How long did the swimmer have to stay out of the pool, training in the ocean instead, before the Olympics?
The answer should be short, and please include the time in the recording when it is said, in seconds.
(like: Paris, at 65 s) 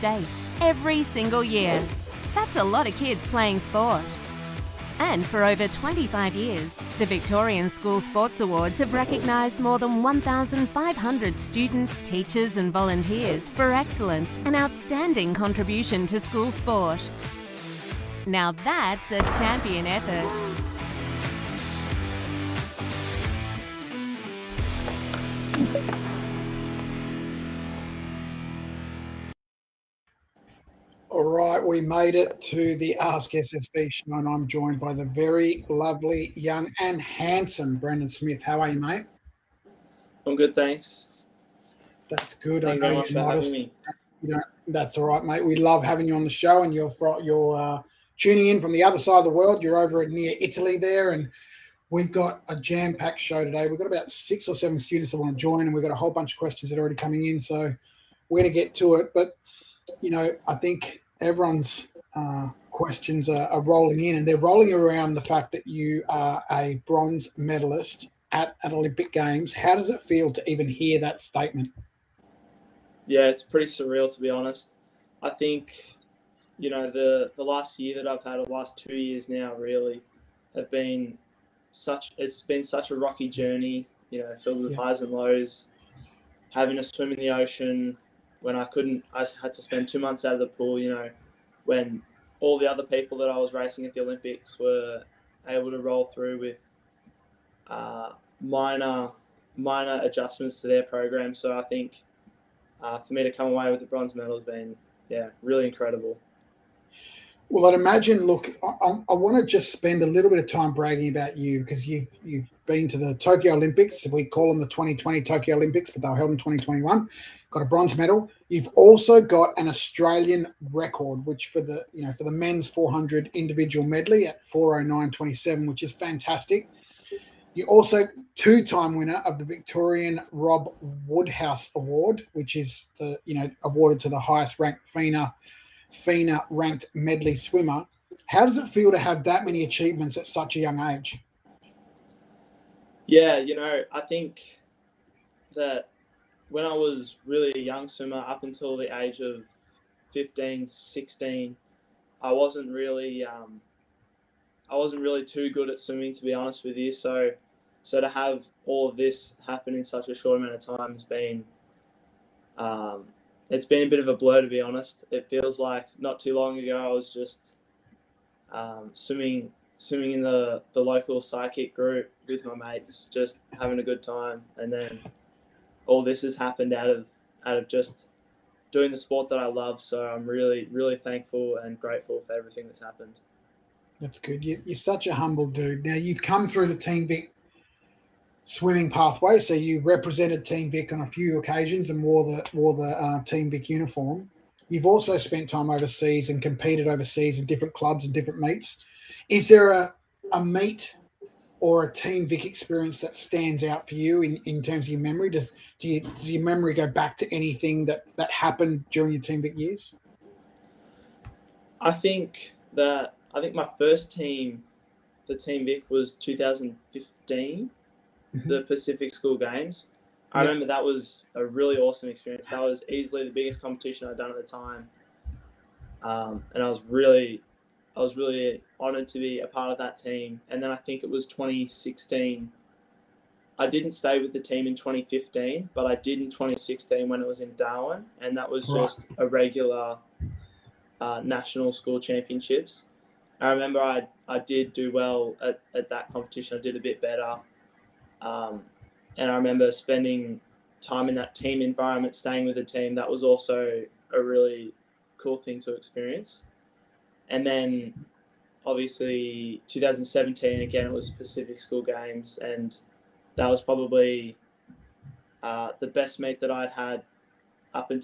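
Two months, at 89 s.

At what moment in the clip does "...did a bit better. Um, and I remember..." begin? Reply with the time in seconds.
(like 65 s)
246 s.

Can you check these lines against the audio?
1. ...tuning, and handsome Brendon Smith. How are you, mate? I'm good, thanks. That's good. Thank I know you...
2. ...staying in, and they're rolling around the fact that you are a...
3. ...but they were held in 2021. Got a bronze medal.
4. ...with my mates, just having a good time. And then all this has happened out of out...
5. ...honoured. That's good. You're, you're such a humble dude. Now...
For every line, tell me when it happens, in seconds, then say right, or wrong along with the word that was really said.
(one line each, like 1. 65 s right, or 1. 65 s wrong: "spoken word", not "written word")
1. 36 s wrong: "young", not "tuning"
2. 63 s wrong: "rolling", not "staying"
3. 115 s right
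4. 172 s right
5. 182 s wrong: "happened", not "honoured".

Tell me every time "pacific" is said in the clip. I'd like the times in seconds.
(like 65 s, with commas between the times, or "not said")
218 s, 261 s.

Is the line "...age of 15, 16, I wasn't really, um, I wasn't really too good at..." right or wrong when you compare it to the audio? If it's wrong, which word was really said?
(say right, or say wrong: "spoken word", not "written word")
right.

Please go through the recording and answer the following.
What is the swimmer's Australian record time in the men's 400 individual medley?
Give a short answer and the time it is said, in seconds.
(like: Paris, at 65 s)
4:09.27, at 124 s.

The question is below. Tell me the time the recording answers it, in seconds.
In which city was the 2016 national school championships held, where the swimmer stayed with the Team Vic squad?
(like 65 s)
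237 s.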